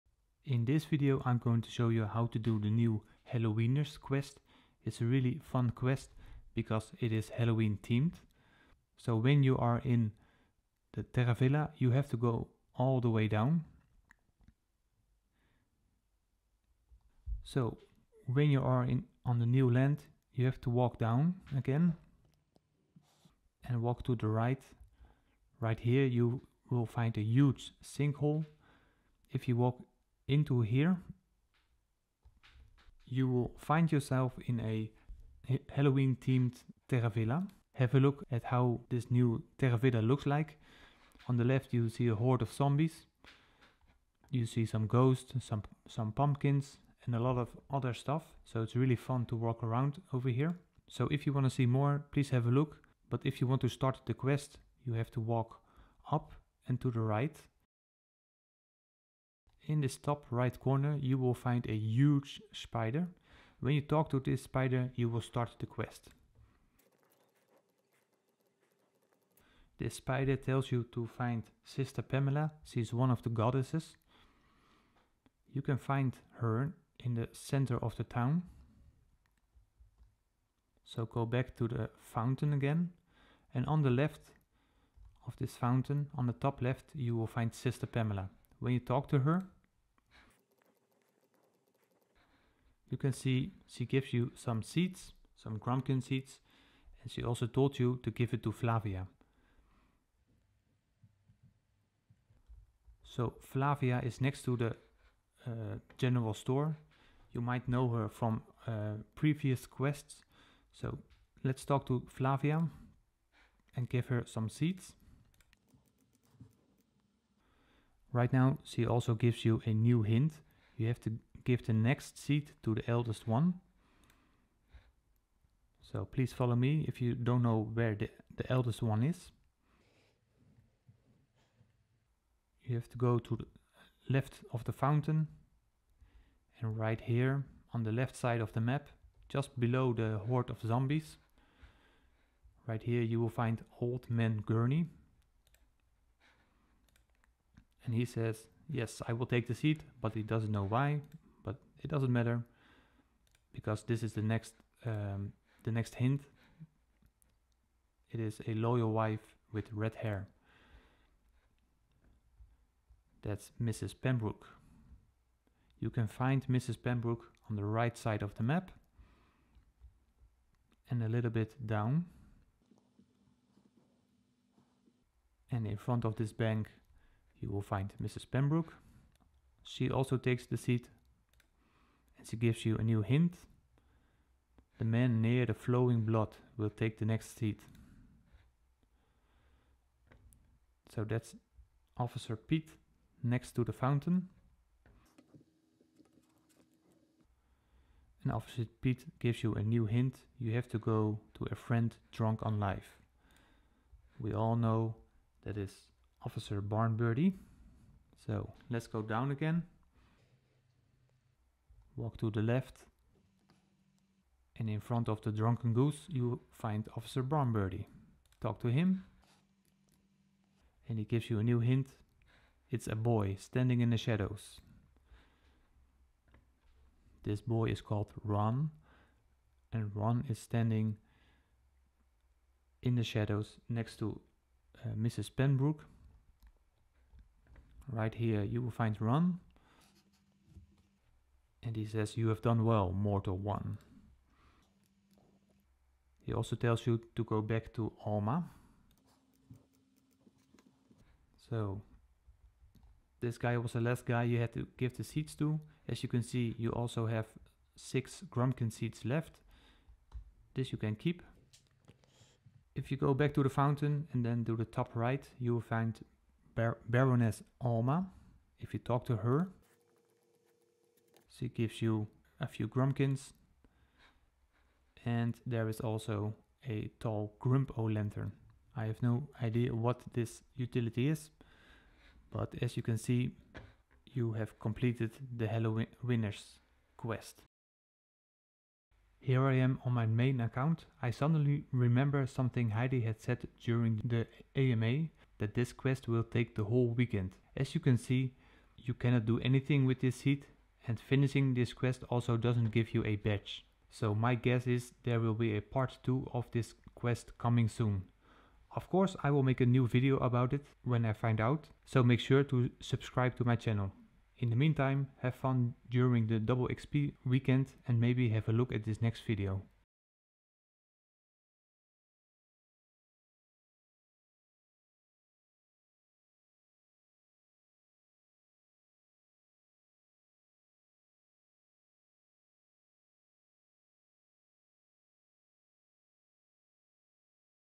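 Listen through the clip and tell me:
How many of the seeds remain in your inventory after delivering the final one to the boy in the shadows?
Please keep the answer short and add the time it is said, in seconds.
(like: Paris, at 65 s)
6, at 257 s.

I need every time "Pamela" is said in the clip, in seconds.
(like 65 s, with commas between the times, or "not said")
72 s, 87 s.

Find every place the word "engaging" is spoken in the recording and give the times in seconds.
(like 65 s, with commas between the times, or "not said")
not said.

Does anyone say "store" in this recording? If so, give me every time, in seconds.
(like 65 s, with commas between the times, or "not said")
106 s.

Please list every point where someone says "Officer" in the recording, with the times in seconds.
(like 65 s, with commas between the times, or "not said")
191 s, 198 s, 206 s, 216 s.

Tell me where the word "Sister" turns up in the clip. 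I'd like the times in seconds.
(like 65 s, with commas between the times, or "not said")
71 s, 87 s.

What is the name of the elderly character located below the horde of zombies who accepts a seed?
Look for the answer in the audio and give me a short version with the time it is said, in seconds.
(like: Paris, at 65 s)
Old Man Gurney, at 143 s.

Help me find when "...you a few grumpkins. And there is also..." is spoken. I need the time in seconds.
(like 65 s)
271 s.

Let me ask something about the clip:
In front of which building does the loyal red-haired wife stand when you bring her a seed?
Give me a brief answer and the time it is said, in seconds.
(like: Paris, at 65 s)
Bank, at 176 s.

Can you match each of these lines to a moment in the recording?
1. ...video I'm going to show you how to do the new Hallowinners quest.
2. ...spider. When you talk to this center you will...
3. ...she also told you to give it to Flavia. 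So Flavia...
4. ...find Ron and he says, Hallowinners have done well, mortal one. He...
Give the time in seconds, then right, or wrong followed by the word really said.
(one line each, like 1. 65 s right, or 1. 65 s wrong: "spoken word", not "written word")
1. 0 s right
2. 62 s wrong: "spider", not "center"
3. 97 s right
4. 238 s wrong: "You", not "Hallowinners".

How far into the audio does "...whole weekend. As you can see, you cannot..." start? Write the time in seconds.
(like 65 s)
296 s.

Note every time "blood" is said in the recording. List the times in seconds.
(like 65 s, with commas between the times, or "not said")
186 s.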